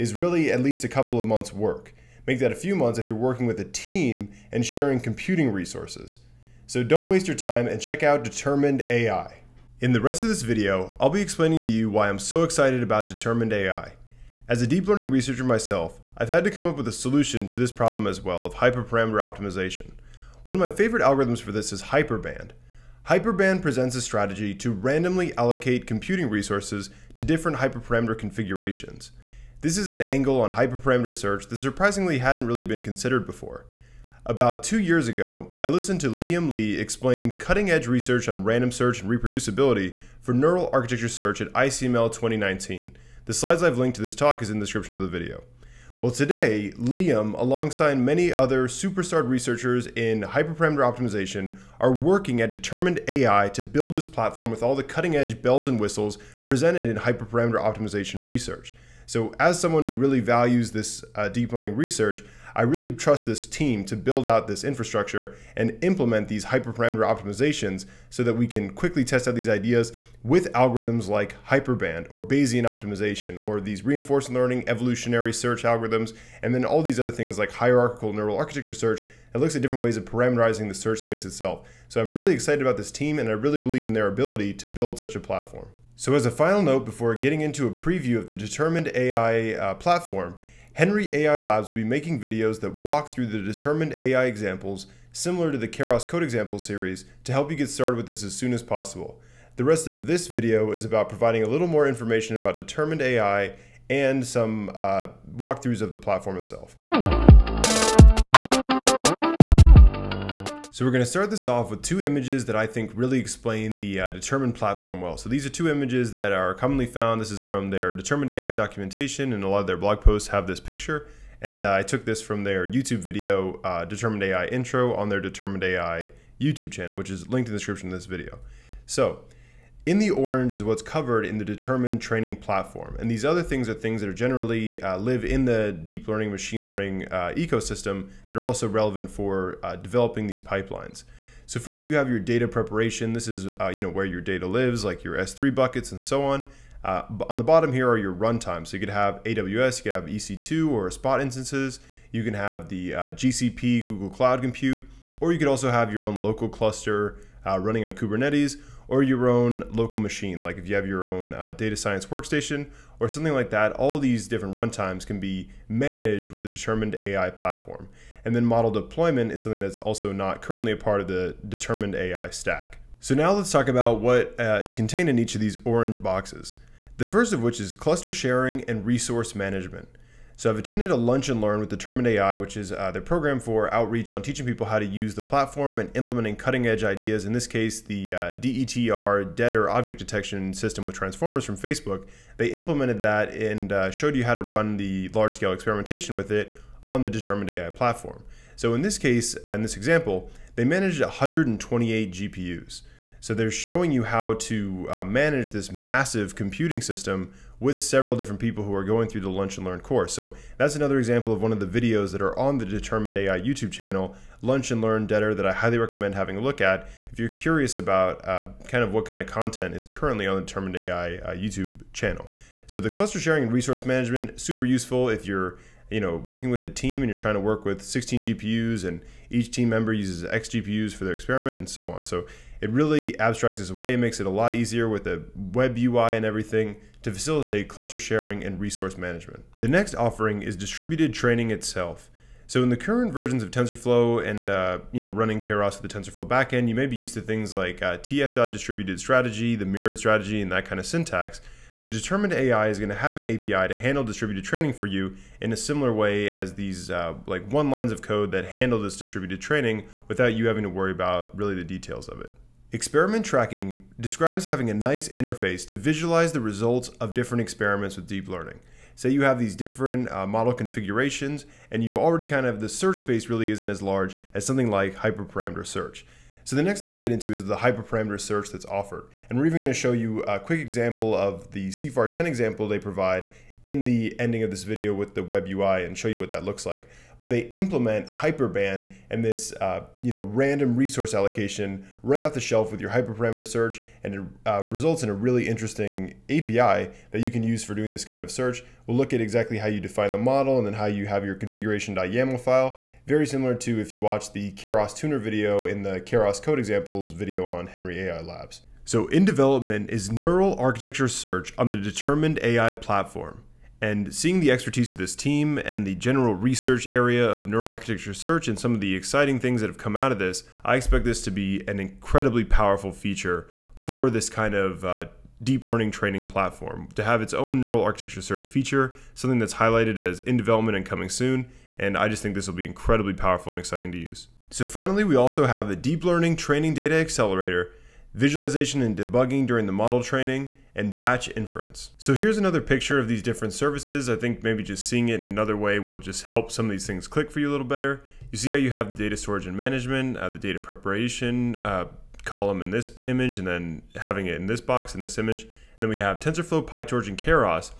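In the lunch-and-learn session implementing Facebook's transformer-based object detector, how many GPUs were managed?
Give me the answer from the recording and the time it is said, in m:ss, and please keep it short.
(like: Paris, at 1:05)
128, at 3:21.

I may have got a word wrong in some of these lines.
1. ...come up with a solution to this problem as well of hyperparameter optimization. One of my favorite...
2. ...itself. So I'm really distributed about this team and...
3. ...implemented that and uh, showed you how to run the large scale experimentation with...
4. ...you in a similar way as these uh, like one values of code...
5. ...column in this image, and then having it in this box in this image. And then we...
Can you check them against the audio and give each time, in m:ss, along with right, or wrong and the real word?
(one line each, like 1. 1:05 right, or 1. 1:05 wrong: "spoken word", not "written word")
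1. 0:16 right
2. 1:21 wrong: "excited", not "distributed"
3. 3:12 right
4. 4:14 wrong: "lines", not "values"
5. 5:52 right.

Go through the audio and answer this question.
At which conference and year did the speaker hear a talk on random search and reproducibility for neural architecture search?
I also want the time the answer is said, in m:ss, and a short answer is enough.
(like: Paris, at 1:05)
ICML 2019, at 0:41.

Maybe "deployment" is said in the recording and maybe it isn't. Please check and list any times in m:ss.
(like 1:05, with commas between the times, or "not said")
2:48.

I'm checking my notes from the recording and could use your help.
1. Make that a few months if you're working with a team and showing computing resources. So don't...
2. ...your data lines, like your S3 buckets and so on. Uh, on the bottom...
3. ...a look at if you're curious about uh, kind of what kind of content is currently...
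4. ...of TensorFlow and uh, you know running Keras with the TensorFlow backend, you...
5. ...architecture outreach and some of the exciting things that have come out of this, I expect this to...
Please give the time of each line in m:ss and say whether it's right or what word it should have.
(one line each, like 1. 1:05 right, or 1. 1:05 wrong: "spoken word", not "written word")
1. 0:02 wrong: "sharing", not "showing"
2. 2:24 wrong: "lives", not "lines"
3. 3:36 right
4. 4:03 right
5. 5:17 wrong: "search", not "outreach".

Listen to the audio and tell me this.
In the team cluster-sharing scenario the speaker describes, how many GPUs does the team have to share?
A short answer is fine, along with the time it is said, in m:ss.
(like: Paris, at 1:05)
16, at 3:47.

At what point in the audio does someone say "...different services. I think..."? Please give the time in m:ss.
5:43.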